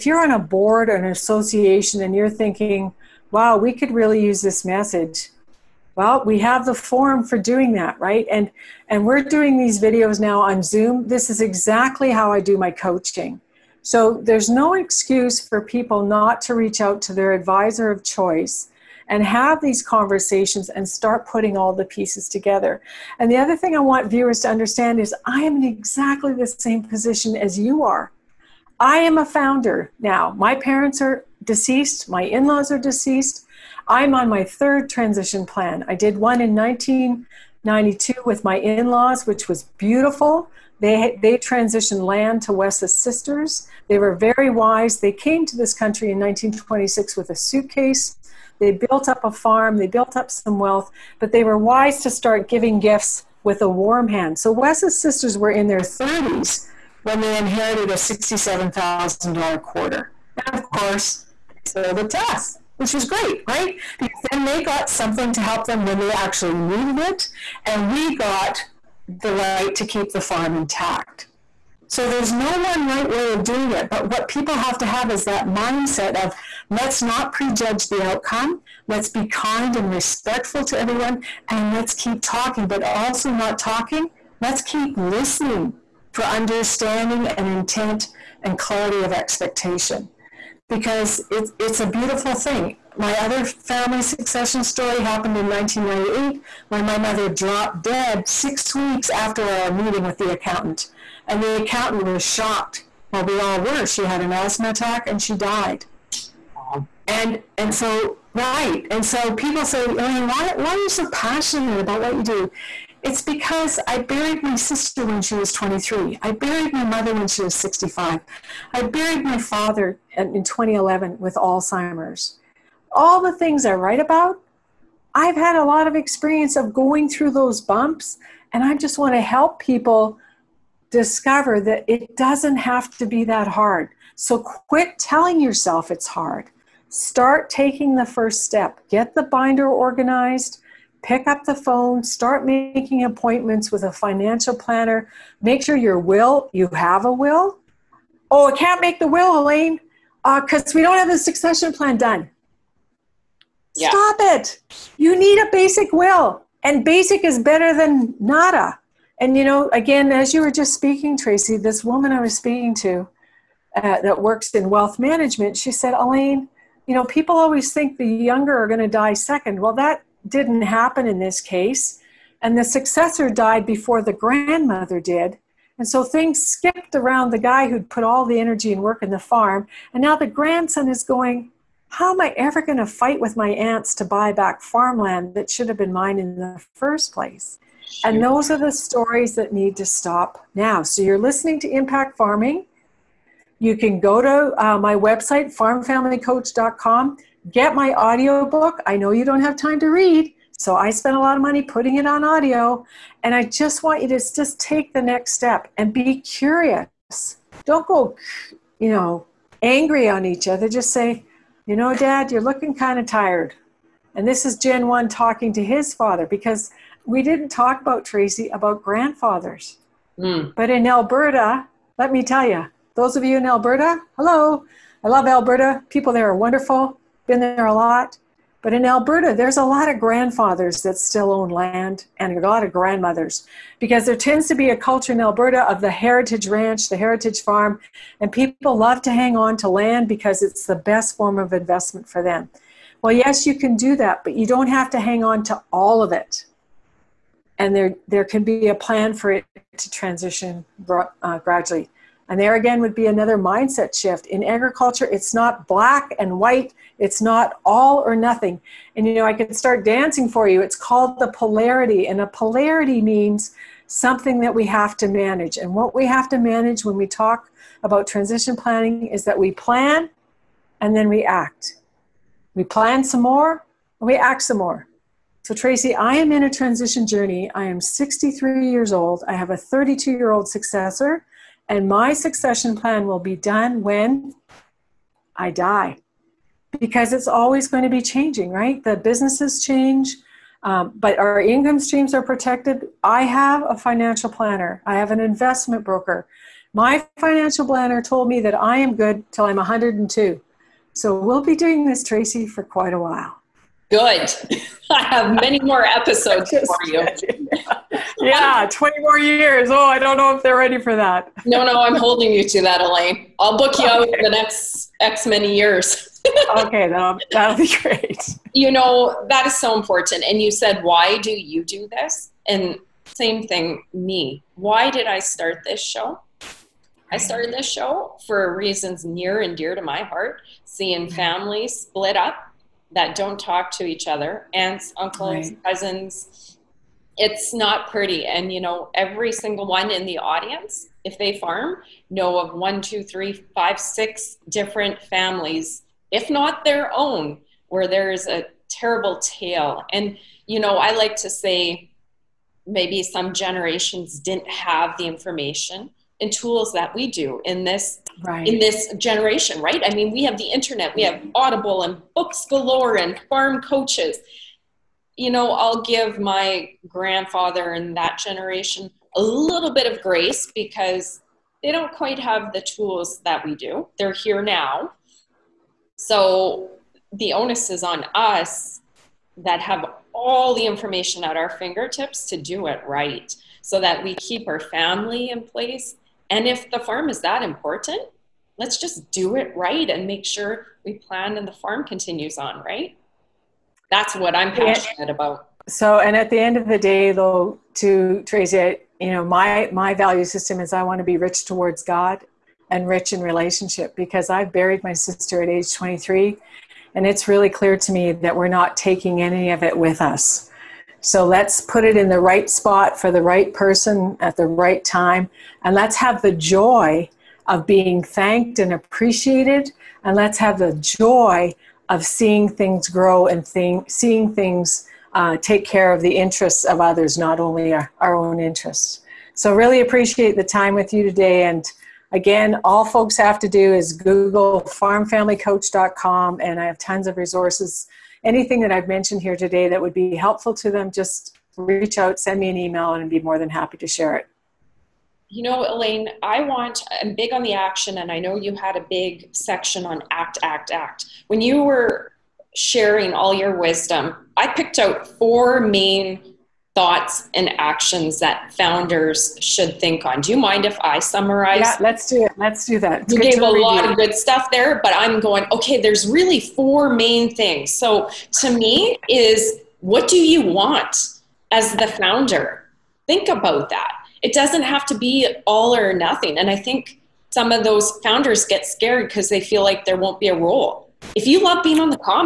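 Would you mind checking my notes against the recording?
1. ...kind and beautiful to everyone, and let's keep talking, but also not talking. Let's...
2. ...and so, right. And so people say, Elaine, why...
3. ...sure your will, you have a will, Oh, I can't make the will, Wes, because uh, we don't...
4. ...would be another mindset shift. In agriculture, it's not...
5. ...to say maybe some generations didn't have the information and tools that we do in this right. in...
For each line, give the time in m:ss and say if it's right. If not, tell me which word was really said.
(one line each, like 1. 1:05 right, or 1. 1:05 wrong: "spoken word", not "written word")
1. 1:19 wrong: "respectful", not "beautiful"
2. 1:47 right
3. 2:25 wrong: "Elaine", not "Wes"
4. 4:12 right
5. 5:51 right.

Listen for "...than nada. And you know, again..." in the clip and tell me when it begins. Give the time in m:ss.
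2:37.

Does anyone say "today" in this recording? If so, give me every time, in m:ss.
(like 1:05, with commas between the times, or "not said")
7:11, 7:19.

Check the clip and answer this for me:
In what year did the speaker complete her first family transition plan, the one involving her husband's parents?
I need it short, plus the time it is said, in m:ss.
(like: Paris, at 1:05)
1992, at 0:36.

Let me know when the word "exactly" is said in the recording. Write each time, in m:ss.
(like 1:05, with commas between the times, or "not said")
0:11, 0:25.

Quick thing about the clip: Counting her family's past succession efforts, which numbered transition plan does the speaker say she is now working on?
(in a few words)
third.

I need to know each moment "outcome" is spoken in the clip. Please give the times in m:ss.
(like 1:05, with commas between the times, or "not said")
1:18.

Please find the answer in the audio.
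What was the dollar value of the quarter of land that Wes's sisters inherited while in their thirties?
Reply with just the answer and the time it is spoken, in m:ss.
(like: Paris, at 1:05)
$67,000, at 0:57.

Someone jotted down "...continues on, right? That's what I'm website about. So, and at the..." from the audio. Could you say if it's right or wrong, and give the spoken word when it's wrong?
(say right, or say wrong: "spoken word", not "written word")
wrong: "passionate", not "website".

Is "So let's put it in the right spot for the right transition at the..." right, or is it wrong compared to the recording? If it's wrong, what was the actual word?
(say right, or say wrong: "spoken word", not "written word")
wrong: "person", not "transition".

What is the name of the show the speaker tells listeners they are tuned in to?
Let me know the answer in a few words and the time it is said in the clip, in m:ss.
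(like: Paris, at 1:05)
Impact Farming, at 3:11.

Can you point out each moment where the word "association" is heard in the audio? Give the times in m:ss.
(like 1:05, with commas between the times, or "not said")
0:01.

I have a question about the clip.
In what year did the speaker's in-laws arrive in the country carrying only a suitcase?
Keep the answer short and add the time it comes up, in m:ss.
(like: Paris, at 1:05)
1926, at 0:46.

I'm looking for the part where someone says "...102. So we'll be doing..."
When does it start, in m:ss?
4:59.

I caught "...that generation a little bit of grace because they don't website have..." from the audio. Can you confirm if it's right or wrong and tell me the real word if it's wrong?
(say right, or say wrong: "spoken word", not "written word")
wrong: "quite", not "website".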